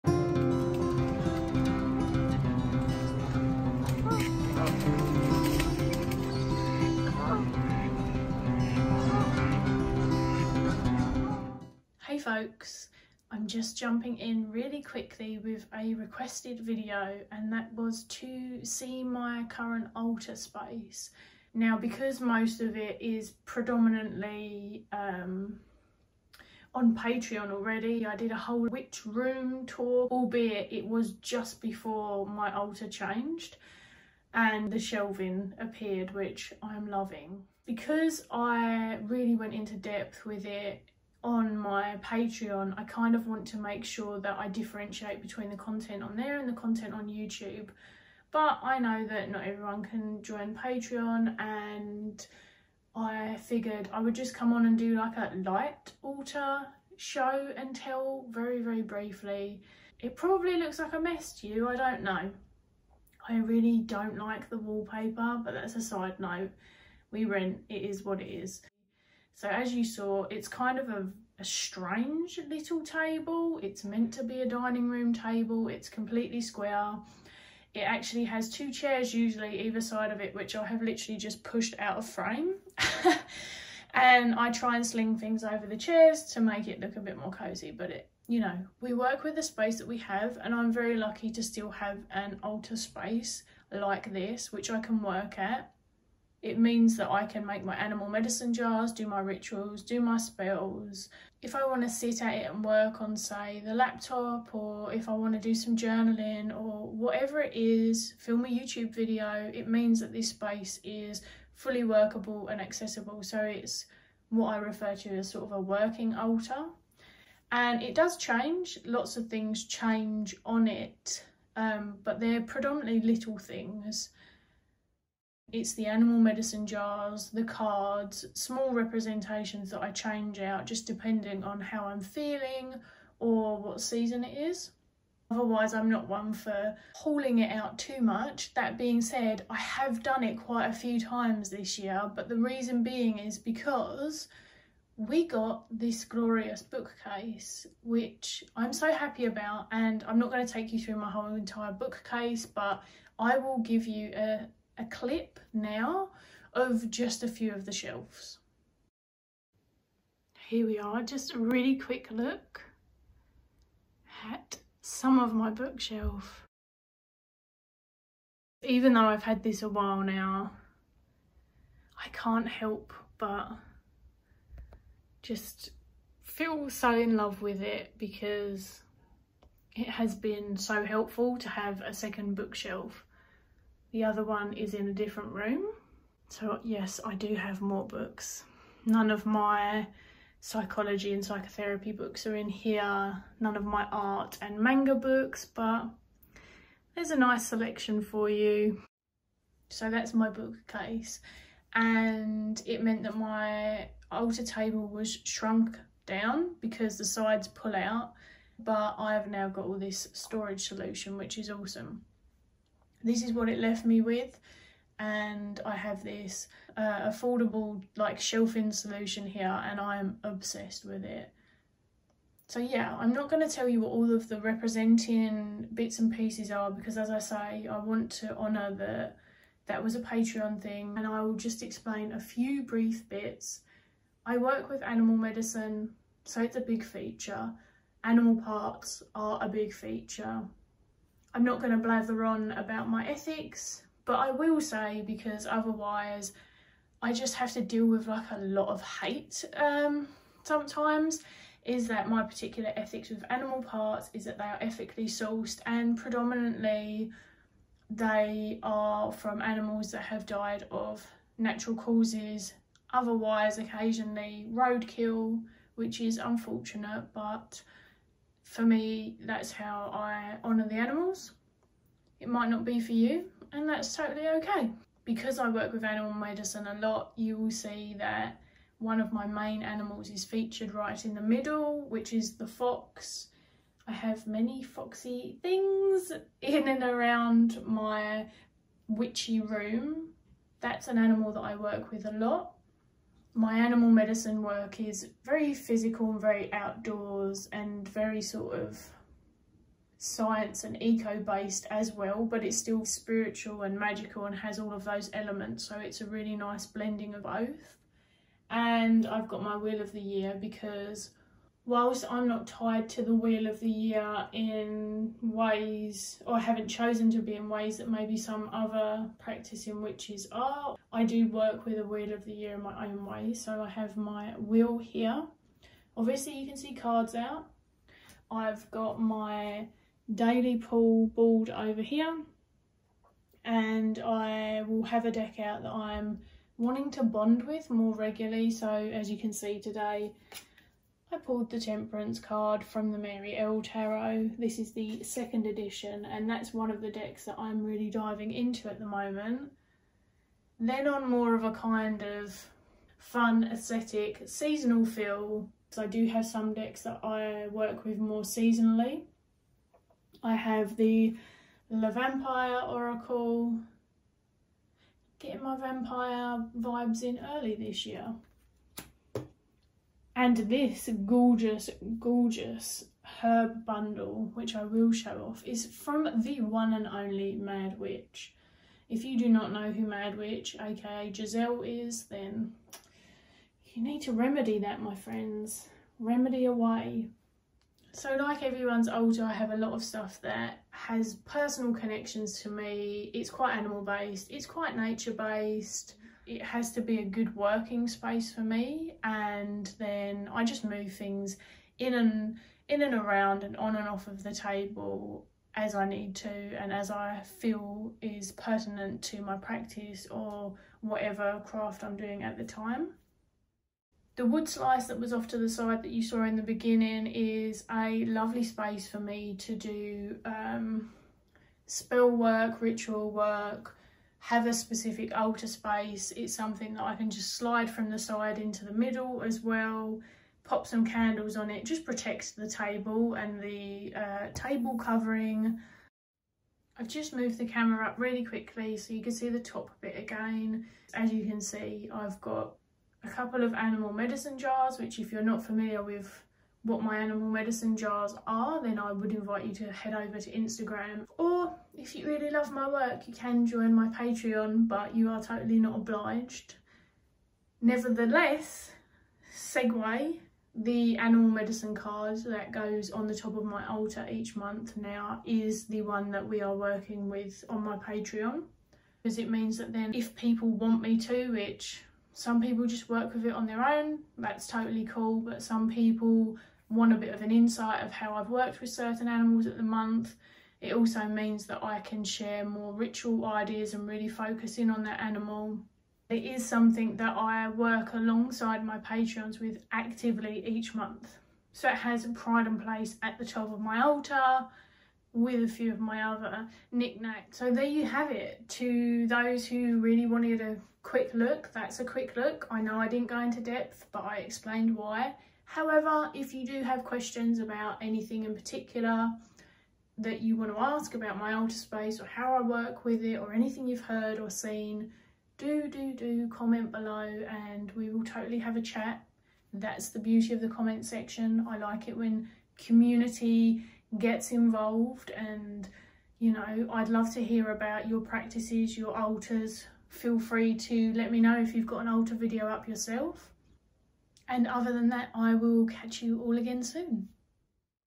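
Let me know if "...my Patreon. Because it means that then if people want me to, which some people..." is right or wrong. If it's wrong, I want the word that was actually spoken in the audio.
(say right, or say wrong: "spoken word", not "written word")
right.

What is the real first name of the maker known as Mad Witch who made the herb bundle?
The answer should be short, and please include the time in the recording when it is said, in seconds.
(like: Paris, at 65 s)
Giselle, at 381 s.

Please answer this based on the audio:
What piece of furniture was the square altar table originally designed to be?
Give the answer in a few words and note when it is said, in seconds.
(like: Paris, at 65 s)
Dining room table, at 74 s.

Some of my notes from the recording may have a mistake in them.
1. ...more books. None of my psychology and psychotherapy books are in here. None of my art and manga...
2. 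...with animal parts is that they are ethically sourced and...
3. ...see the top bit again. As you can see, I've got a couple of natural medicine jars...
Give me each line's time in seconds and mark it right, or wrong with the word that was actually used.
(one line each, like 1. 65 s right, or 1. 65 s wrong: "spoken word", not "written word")
1. 187 s right
2. 253 s right
3. 439 s wrong: "animal", not "natural".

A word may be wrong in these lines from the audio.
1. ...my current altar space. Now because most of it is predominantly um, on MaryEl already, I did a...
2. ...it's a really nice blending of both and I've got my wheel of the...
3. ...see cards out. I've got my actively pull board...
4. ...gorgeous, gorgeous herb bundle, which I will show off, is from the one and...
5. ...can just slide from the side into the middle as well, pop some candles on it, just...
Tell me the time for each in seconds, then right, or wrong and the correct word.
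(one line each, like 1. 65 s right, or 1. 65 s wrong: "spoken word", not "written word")
1. 19 s wrong: "Patreon", not "MaryEl"
2. 305 s right
3. 326 s wrong: "daily", not "actively"
4. 371 s right
5. 426 s right.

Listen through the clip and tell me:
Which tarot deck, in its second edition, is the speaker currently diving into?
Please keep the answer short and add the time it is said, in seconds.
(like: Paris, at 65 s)
Mary-El Tarot, at 342 s.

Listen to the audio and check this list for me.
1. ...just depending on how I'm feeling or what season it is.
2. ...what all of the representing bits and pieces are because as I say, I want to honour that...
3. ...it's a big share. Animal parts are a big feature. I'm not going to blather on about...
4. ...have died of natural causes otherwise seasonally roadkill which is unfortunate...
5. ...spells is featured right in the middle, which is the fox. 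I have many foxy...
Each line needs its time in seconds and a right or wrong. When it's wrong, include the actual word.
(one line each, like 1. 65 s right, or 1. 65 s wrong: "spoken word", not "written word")
1. 130 s right
2. 223 s right
3. 236 s wrong: "feature", not "share"
4. 260 s wrong: "occasionally", not "seasonally"
5. 279 s wrong: "animals", not "spells".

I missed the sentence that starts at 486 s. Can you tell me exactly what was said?
It is something that I work alongside my patrons with actively each month.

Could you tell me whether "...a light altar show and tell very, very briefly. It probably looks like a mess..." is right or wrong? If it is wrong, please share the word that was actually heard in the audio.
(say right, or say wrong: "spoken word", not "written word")
right.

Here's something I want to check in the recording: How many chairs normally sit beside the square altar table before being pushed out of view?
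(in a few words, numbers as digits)
2.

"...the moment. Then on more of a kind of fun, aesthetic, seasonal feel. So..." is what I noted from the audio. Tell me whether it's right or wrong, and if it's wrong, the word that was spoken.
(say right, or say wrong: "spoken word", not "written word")
right.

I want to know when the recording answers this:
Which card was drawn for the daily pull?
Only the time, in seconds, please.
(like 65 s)
341 s.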